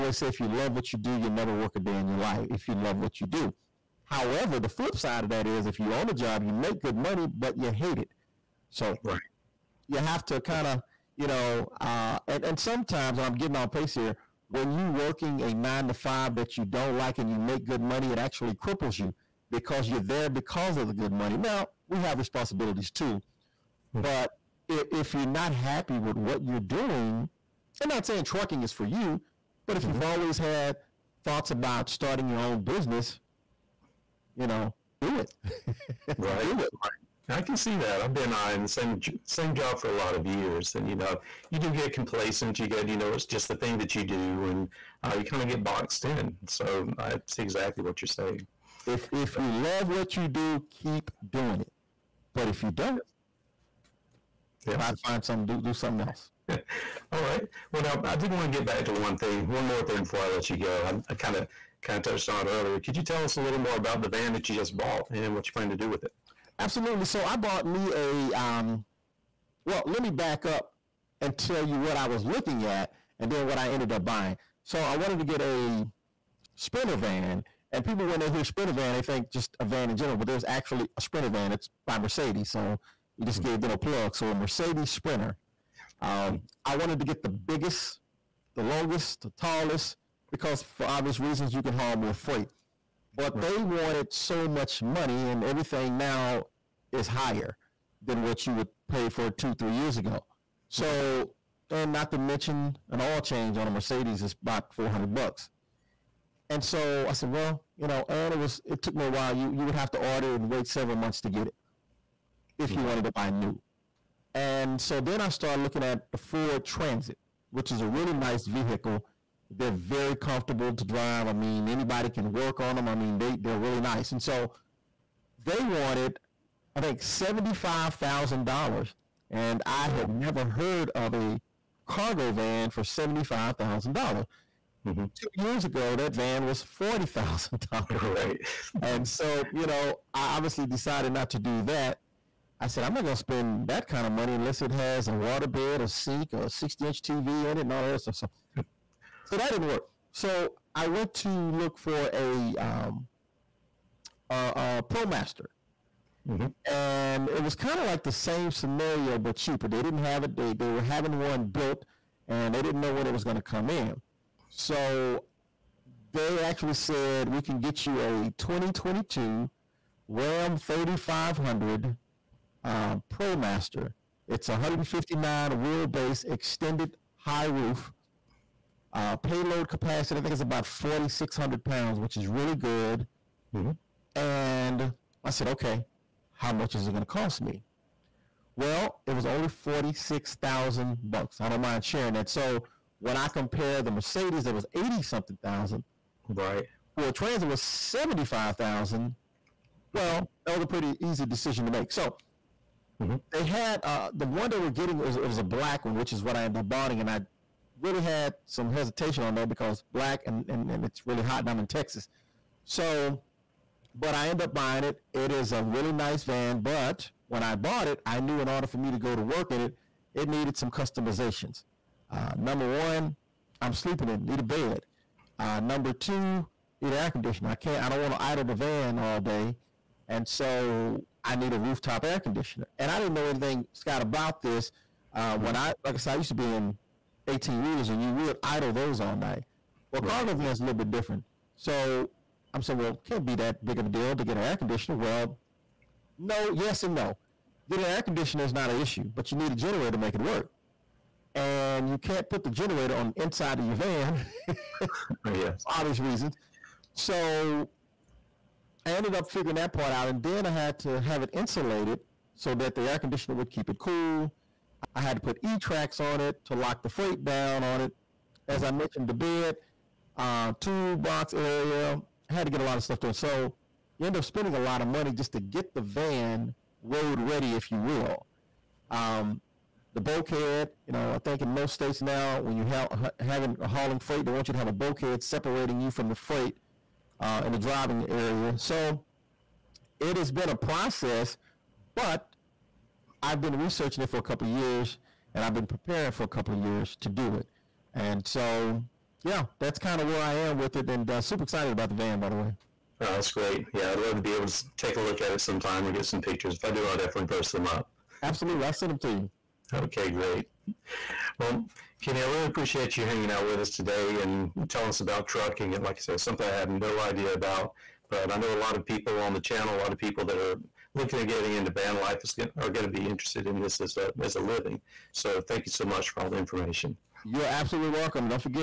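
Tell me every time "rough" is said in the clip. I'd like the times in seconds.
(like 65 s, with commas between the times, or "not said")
not said.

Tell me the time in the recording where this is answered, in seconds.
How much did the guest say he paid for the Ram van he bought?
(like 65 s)
189 s.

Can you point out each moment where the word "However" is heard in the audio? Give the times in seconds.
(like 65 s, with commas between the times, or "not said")
4 s.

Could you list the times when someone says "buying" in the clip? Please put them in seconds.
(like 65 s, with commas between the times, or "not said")
74 s, 206 s, 214 s.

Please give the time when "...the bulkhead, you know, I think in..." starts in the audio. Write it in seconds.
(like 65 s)
279 s.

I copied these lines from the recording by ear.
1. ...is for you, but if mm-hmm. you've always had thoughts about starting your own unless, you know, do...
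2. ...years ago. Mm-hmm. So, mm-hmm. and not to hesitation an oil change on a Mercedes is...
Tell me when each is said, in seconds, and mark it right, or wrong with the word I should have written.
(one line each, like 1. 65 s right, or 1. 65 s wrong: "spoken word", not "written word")
1. 28 s wrong: "business", not "unless"
2. 99 s wrong: "mention", not "hesitation".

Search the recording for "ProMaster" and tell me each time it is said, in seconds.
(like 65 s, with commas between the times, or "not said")
154 s, 173 s.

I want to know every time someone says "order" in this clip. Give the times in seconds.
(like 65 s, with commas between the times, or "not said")
109 s, 218 s.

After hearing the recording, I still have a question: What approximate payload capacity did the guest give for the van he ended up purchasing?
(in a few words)
4,600 pounds.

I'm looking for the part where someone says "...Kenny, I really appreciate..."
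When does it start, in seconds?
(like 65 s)
312 s.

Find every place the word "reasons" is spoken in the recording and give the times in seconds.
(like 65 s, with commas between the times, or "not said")
91 s, 255 s.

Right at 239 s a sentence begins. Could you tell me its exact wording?
Well, cargo van's a little bit different.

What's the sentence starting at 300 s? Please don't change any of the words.
And uh, super excited about the van, by the way.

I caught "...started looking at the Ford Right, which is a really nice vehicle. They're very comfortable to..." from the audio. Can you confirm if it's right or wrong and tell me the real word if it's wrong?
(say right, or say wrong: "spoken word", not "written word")
wrong: "Transit", not "Right".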